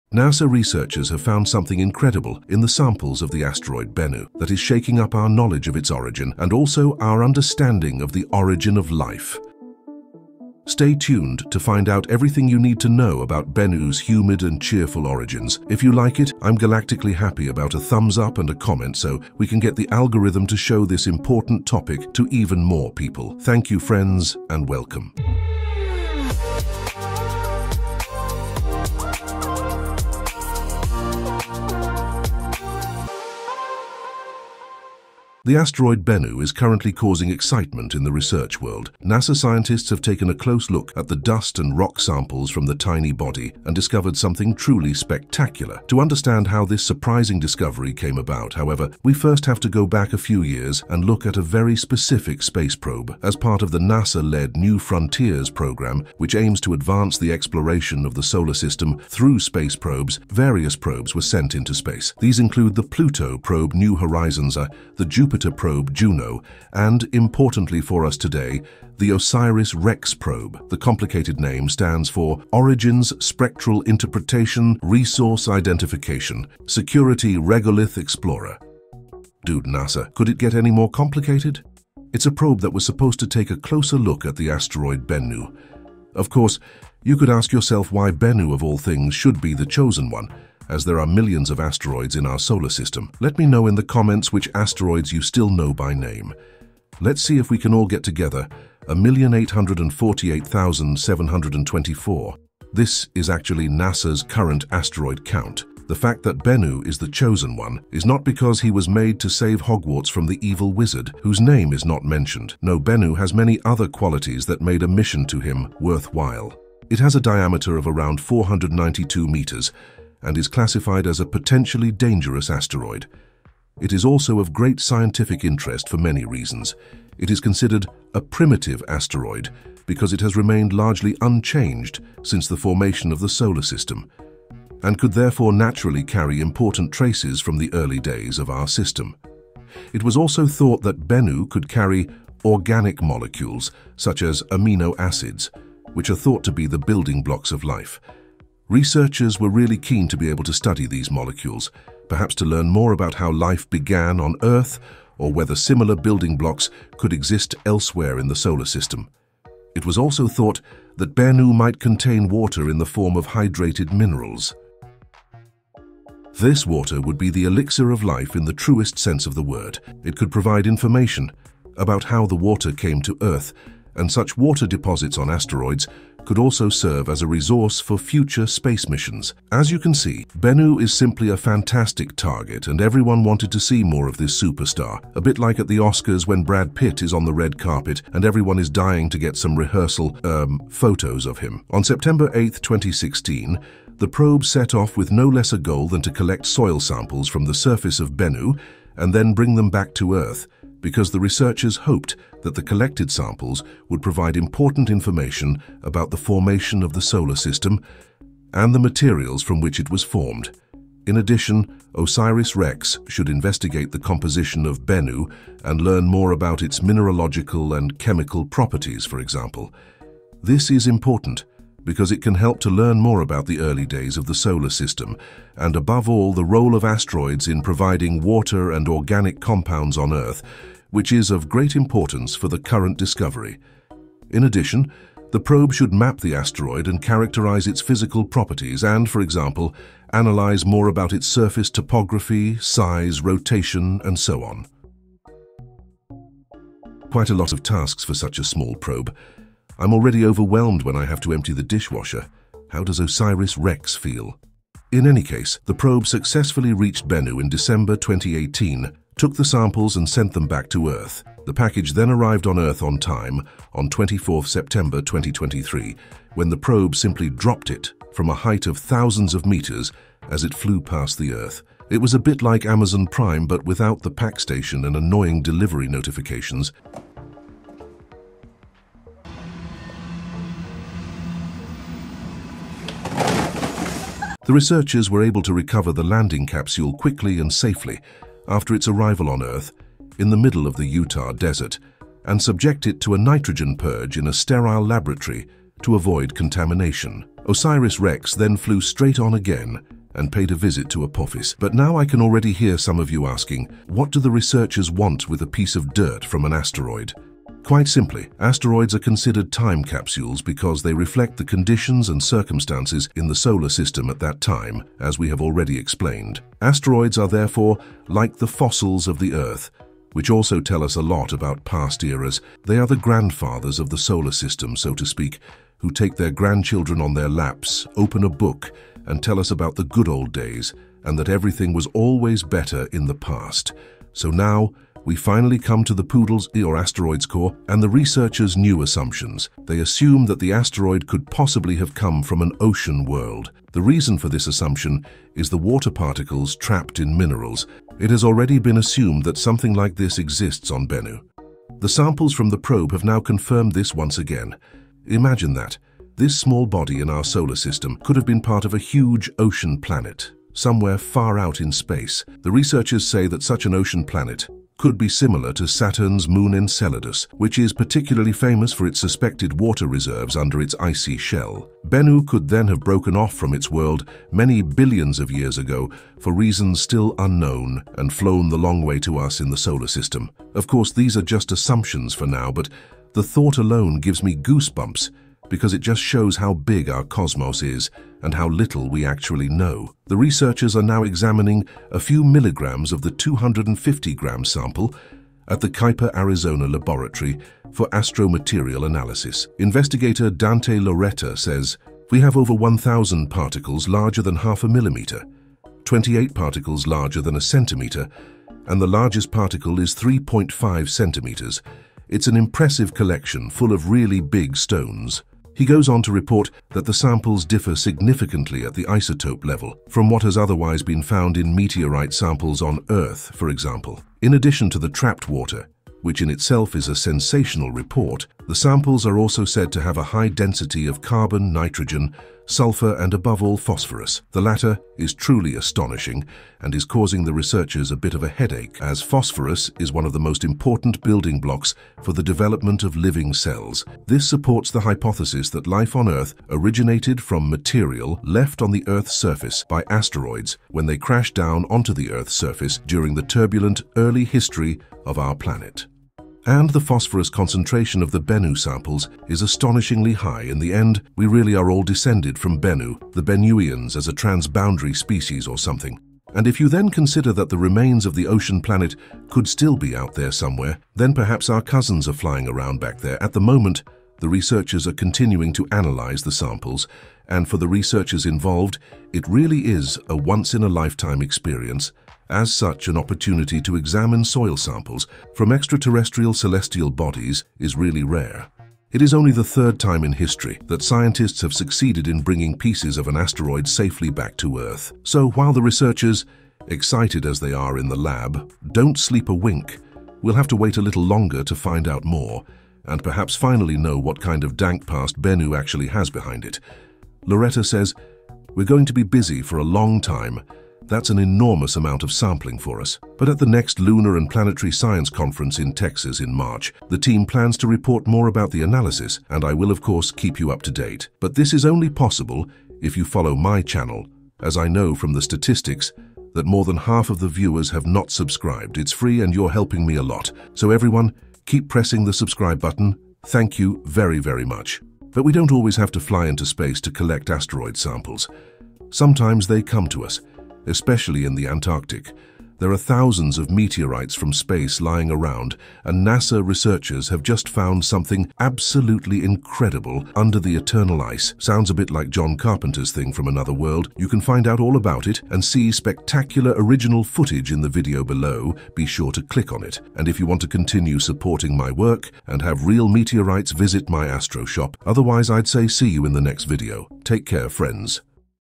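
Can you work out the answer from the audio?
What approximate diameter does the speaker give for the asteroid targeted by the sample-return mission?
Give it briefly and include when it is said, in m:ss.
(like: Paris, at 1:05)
492 meters, at 1:58.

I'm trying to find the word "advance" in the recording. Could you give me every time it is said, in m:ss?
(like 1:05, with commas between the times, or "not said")
0:56.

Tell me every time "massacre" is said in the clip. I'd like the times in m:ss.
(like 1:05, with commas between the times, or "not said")
not said.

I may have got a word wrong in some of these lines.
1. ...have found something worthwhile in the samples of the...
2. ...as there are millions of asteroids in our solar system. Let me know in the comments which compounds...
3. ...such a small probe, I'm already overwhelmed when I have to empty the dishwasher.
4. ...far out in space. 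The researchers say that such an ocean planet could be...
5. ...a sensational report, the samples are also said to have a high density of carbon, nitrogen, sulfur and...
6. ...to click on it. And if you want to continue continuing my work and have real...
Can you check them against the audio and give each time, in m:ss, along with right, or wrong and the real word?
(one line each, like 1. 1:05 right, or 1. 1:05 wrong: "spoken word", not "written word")
1. 0:01 wrong: "incredible", not "worthwhile"
2. 1:30 wrong: "asteroids", not "compounds"
3. 4:08 right
4. 6:00 right
5. 7:06 right
6. 9:19 wrong: "supporting", not "continuing".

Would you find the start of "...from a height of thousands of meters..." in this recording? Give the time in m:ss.
4:28.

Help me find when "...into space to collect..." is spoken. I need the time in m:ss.
8:56.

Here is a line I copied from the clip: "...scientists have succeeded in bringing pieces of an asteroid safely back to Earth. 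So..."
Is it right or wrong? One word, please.
right.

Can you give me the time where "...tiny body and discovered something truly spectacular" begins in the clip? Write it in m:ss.
0:42.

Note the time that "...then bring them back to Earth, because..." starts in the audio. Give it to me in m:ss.
3:19.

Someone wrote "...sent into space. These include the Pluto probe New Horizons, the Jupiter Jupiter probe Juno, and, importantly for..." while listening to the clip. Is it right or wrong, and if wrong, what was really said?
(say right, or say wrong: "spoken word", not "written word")
right.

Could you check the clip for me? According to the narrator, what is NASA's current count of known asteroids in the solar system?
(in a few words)
1,848,724.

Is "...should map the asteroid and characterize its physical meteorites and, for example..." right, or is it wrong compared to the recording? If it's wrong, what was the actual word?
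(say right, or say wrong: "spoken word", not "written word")
wrong: "properties", not "meteorites".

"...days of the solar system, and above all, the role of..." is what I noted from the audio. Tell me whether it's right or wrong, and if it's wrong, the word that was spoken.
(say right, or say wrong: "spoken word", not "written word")
right.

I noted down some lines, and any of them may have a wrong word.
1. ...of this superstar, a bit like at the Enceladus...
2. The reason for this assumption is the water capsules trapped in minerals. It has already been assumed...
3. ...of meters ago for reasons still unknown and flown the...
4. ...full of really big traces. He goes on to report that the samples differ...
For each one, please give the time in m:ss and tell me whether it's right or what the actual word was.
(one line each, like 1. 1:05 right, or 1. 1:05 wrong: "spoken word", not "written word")
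1. 3:04 wrong: "Oscars", not "Enceladus"
2. 5:43 wrong: "particles", not "capsules"
3. 6:15 wrong: "years", not "meters"
4. 6:53 wrong: "stones", not "traces".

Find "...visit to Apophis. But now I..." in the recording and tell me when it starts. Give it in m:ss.
5:00.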